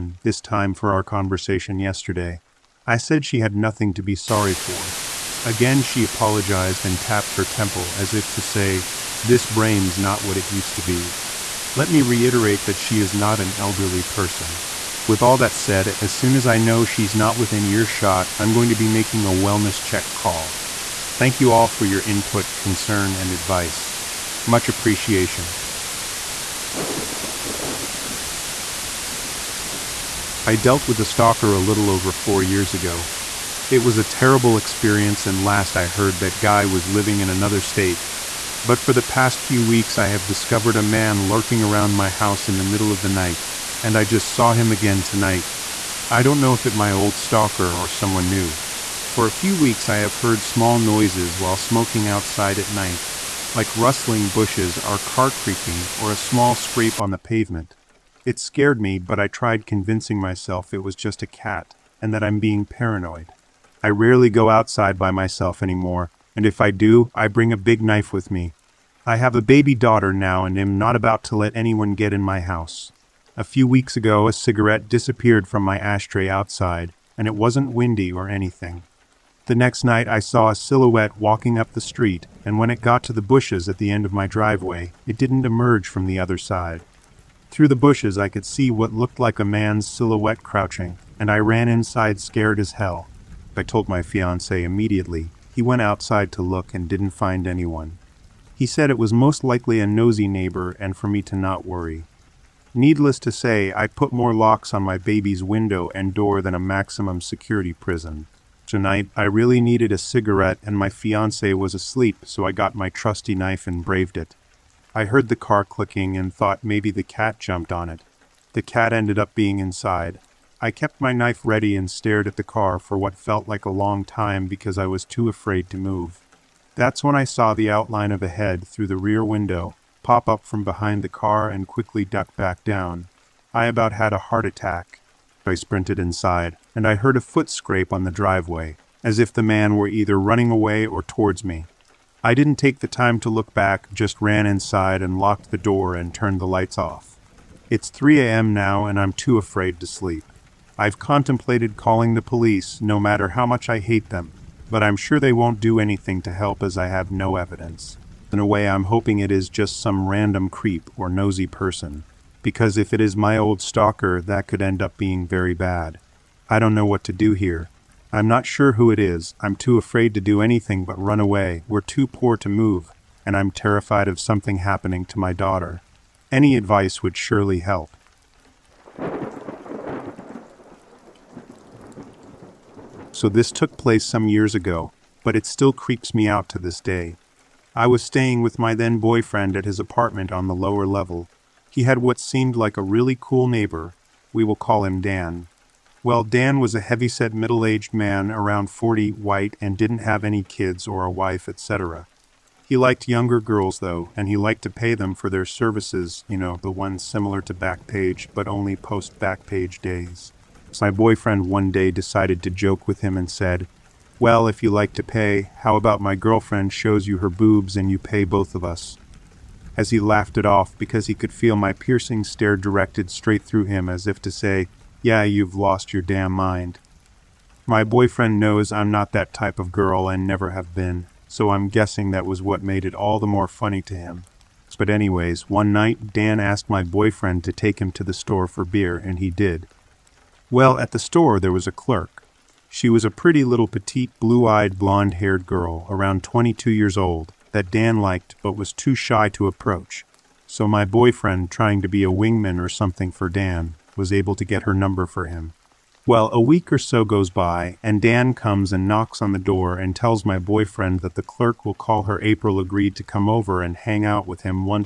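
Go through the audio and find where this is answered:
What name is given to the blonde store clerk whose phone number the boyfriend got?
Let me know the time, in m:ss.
4:22.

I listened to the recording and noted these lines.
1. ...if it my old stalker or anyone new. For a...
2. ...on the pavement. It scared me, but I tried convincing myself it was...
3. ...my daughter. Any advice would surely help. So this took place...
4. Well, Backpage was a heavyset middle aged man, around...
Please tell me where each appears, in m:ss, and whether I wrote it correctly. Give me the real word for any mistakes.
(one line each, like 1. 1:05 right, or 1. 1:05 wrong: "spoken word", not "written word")
1. 0:46 wrong: "someone", not "anyone"
2. 0:56 right
3. 2:55 right
4. 3:16 wrong: "Dan", not "Backpage".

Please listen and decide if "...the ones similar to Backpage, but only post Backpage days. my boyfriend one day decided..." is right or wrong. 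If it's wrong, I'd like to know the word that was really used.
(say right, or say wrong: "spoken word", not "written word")
right.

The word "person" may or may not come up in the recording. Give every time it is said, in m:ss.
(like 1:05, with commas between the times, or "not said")
0:14, 2:41.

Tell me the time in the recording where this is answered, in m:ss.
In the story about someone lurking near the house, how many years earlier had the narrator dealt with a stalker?
0:32.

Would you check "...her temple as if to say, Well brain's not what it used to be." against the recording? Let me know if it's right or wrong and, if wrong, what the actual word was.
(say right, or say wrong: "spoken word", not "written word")
wrong: "This", not "Well".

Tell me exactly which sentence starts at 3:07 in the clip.
I was staying with my then boyfriend at his apartment on the lower level.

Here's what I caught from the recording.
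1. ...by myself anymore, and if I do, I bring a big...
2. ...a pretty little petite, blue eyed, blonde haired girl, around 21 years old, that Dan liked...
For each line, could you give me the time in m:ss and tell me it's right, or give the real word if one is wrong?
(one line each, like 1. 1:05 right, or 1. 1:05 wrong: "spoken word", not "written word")
1. 1:04 right
2. 4:03 wrong: "22", not "21".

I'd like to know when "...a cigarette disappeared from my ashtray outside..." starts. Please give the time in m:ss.
1:14.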